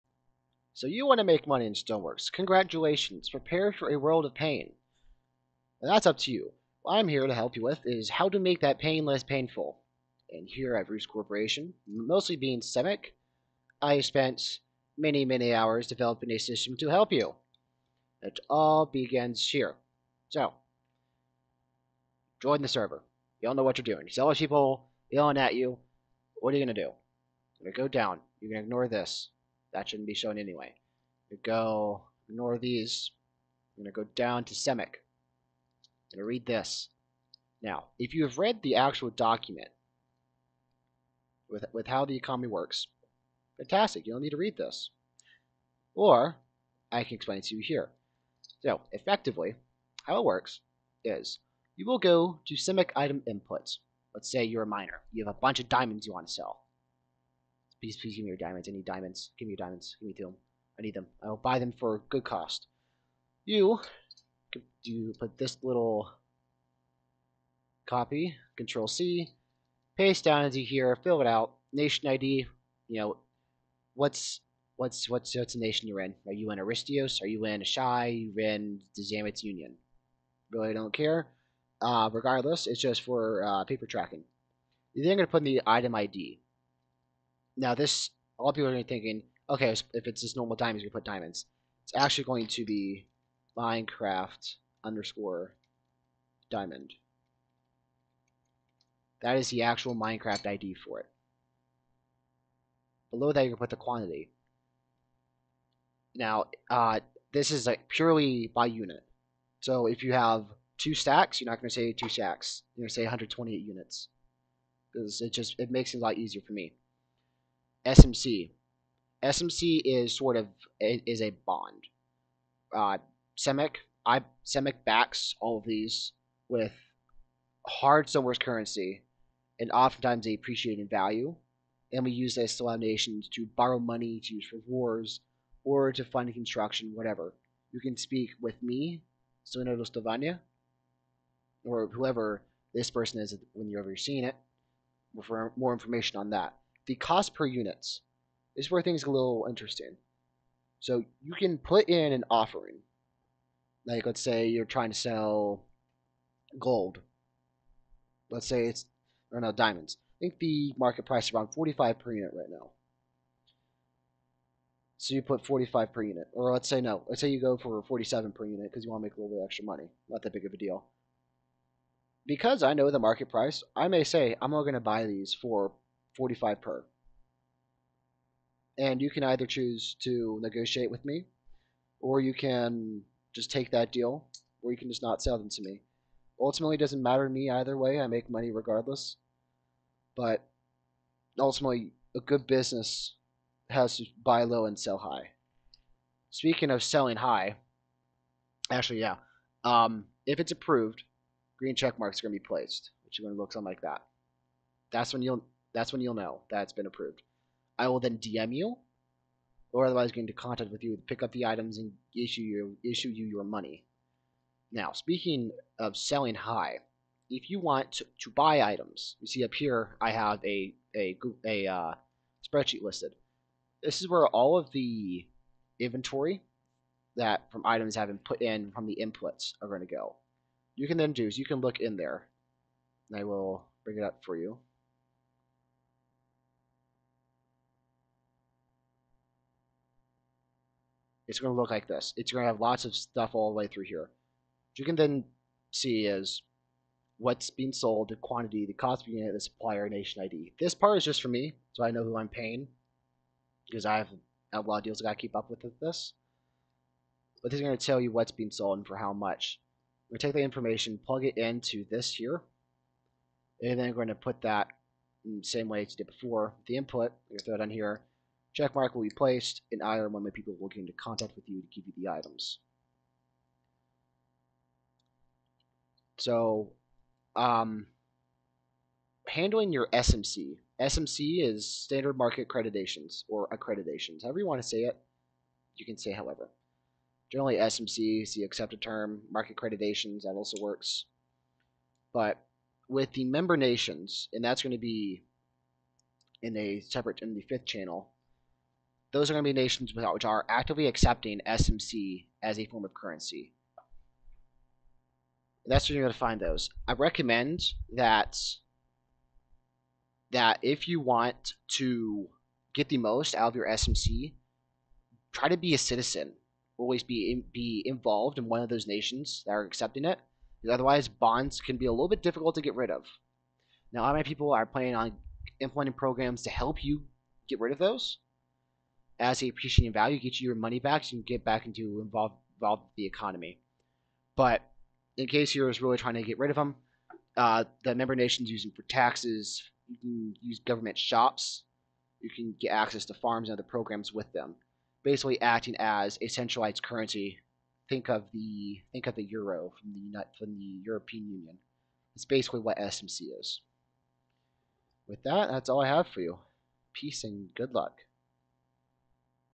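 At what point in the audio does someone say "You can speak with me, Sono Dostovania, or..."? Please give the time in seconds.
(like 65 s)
137 s.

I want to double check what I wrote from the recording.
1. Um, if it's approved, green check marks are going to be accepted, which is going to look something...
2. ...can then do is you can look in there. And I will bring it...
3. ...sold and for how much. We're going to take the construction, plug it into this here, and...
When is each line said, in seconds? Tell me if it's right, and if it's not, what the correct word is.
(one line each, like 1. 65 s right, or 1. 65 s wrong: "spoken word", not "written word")
1. 199 s wrong: "placed", not "accepted"
2. 230 s right
3. 258 s wrong: "information", not "construction".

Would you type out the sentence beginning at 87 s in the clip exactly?
Now this, a lot of people are going to be thinking, okay, if it's just normal diamonds, we put diamonds.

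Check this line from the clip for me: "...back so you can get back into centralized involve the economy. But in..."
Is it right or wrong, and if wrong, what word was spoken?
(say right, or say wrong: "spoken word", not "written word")
wrong: "involved", not "centralized".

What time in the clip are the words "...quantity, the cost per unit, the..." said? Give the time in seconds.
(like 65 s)
248 s.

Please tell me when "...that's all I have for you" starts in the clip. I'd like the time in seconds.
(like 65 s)
355 s.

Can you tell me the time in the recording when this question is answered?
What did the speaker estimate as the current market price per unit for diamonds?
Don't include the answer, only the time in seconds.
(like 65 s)
161 s.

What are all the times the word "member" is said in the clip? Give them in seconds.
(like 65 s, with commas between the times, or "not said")
293 s, 337 s.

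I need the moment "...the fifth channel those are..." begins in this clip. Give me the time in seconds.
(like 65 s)
297 s.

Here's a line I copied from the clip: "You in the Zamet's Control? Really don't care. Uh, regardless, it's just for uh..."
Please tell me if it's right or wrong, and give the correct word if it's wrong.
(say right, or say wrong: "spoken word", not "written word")
wrong: "Union", not "Control".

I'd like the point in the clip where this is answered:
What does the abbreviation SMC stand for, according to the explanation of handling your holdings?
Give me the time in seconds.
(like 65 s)
281 s.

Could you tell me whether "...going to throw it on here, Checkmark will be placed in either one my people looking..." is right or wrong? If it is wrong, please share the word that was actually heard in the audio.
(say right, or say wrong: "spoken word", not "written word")
right.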